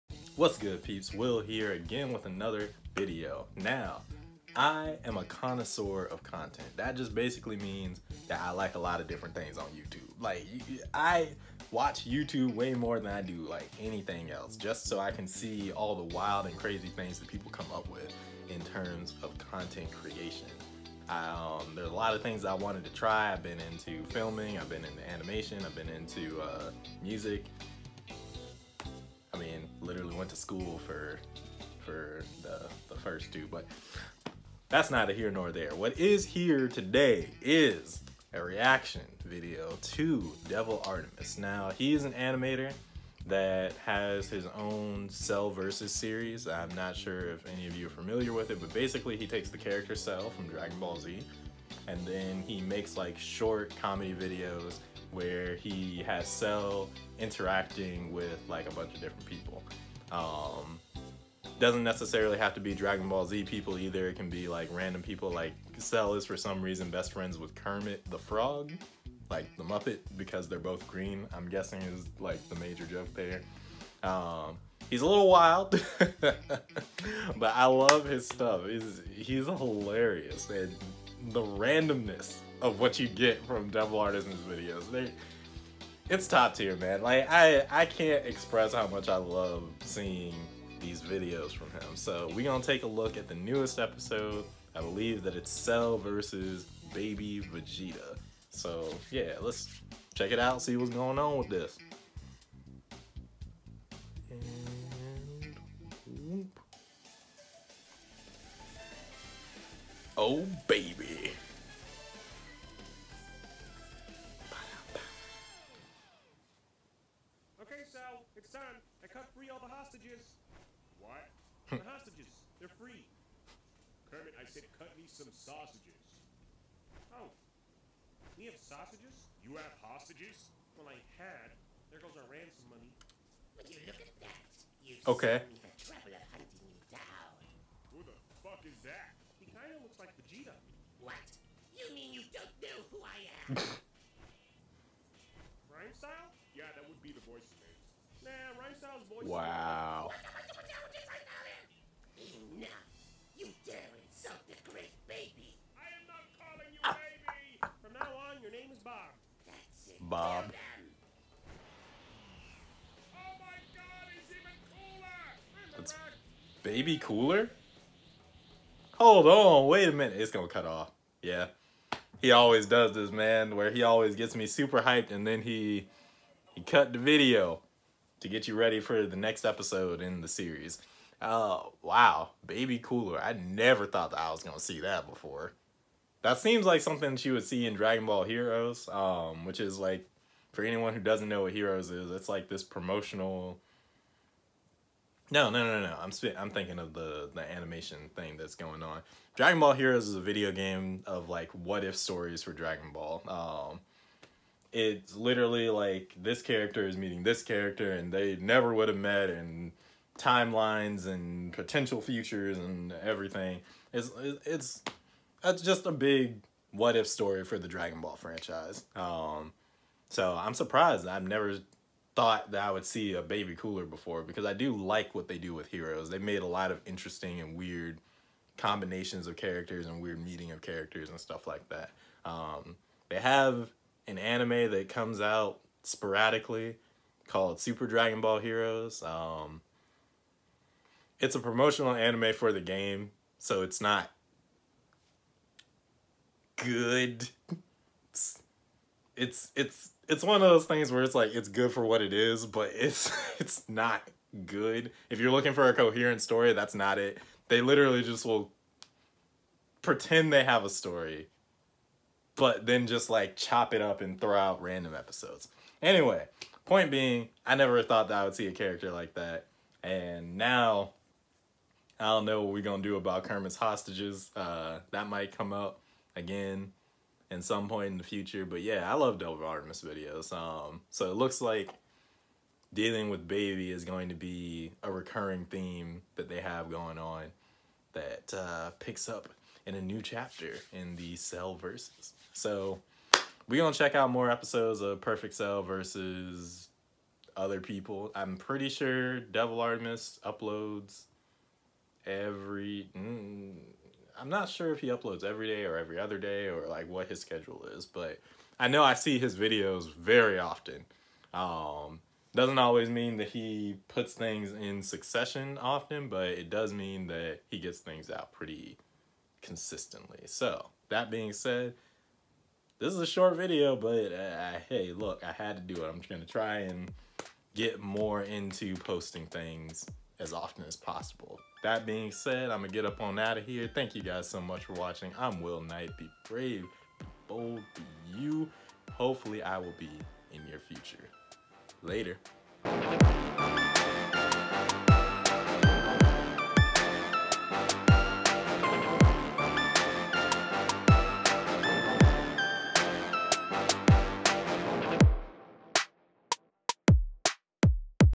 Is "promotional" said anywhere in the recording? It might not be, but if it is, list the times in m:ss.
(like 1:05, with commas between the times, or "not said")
3:12, 4:01.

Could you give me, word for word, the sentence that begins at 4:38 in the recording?
But yeah, I love Dope Artemis videos.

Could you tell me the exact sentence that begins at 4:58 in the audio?
I'm pretty sure Devil Artemis uploads every.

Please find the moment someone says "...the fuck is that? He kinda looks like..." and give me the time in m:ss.
2:18.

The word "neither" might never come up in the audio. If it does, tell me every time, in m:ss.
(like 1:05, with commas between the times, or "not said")
0:34.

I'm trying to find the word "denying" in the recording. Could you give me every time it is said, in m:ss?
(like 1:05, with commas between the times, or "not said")
not said.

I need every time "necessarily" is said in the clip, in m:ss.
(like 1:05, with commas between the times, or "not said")
1:01.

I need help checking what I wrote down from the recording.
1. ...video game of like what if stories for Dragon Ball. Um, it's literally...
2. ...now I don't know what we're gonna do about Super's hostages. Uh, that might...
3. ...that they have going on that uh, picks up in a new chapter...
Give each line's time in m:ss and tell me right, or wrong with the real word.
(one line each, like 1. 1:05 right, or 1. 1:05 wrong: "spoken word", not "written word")
1. 3:20 right
2. 4:30 wrong: "Kermit", not "Super"
3. 4:46 right.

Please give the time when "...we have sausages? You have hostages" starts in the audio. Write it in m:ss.
2:08.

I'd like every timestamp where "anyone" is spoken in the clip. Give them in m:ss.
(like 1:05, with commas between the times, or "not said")
3:10.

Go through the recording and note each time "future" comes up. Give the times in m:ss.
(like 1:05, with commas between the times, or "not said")
3:32, 4:38, 5:40.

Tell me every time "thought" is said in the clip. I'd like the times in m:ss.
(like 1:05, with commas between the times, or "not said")
3:03, 3:42, 4:27.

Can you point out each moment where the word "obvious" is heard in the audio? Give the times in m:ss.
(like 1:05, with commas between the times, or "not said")
not said.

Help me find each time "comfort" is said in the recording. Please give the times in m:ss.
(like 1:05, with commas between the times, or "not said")
not said.